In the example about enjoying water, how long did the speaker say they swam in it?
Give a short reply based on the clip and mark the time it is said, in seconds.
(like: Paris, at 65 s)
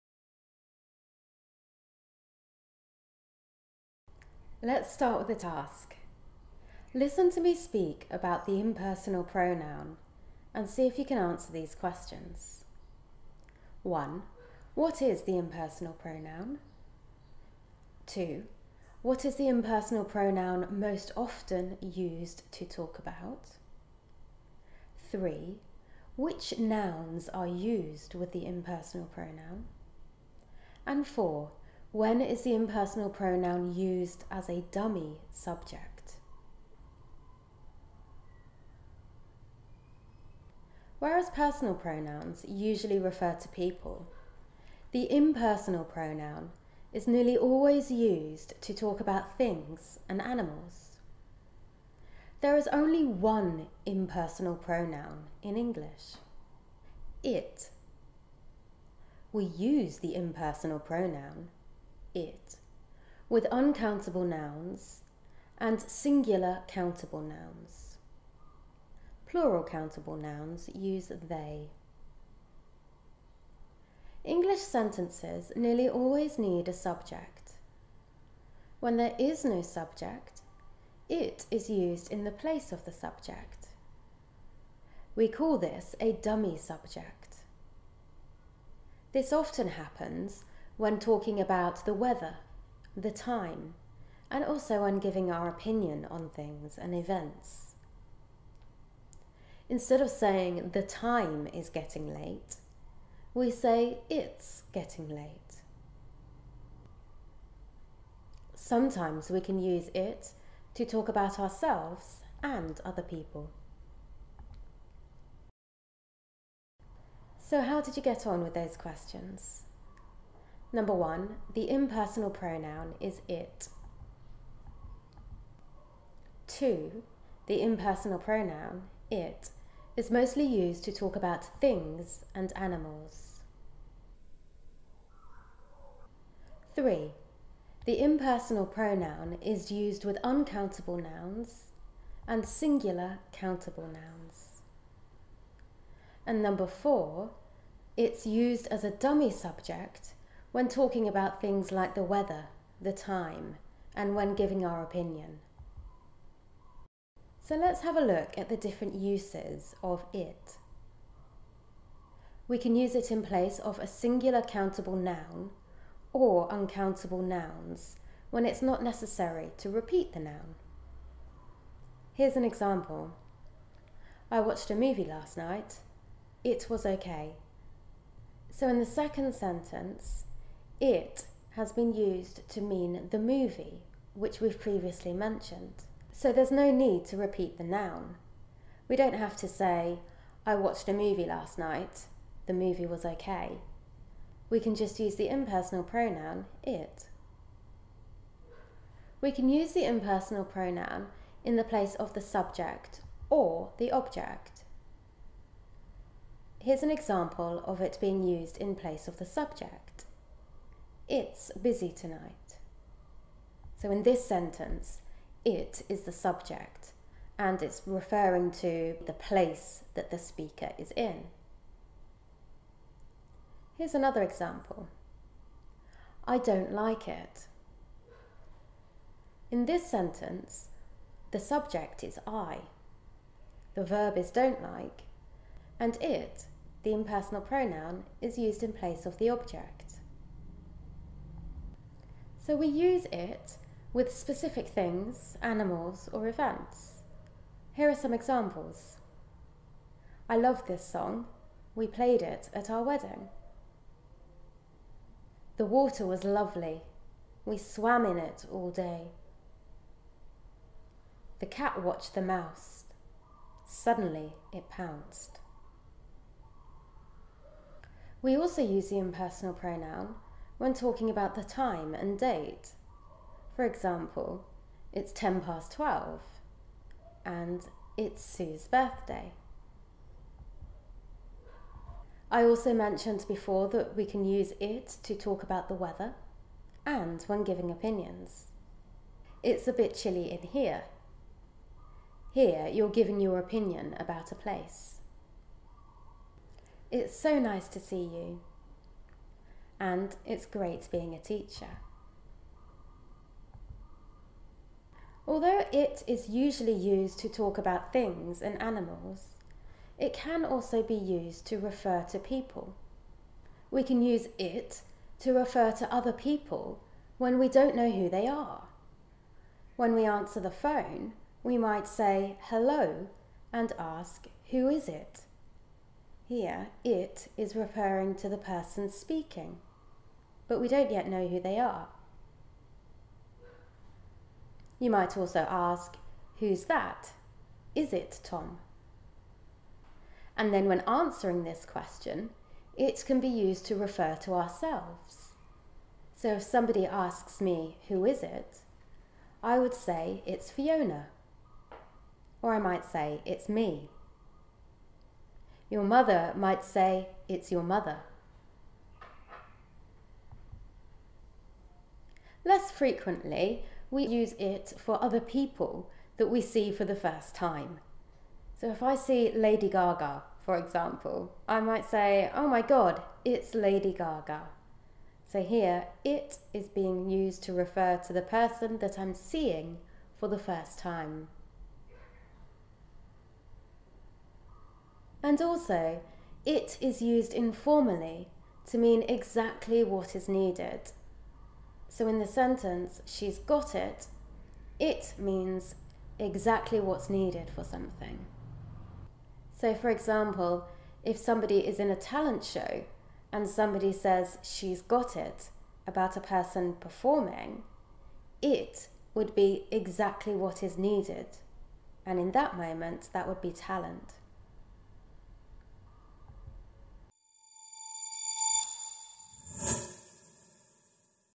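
all day, at 258 s.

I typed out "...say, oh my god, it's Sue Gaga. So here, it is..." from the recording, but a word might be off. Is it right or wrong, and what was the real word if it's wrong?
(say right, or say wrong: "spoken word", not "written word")
wrong: "Lady", not "Sue".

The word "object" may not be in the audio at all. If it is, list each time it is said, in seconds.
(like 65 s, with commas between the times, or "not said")
203 s, 239 s.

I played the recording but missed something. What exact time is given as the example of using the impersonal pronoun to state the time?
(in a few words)
10 past 12.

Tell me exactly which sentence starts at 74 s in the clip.
English sentences nearly always need a subject.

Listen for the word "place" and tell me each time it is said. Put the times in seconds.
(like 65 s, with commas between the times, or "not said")
82 s, 163 s, 201 s, 208 s, 219 s, 238 s, 294 s.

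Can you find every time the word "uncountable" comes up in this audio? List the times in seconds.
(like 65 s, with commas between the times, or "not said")
63 s, 140 s, 166 s.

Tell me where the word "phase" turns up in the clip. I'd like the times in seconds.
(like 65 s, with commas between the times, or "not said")
not said.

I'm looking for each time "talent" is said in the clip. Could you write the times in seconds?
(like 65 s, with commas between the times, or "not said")
401 s, 413 s.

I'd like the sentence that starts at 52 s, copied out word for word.
There is only one impersonal pronoun in English it.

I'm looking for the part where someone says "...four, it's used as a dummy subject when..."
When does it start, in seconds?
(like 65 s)
146 s.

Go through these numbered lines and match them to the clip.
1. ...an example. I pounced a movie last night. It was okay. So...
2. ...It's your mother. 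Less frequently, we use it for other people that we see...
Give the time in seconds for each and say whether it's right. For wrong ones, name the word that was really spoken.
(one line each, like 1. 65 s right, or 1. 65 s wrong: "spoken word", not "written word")
1. 172 s wrong: "watched", not "pounced"
2. 357 s right.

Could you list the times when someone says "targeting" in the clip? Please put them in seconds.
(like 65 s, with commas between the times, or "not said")
not said.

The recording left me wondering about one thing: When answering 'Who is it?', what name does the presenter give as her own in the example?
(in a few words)
Fiona.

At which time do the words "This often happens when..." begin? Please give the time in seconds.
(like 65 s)
89 s.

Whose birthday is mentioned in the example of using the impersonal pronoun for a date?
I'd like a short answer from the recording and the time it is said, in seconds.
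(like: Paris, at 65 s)
Sue's, at 278 s.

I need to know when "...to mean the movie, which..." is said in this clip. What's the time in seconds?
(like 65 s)
182 s.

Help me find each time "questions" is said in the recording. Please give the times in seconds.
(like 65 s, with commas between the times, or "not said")
11 s, 118 s, 341 s.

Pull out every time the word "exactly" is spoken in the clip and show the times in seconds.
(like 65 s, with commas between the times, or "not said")
389 s, 396 s, 409 s.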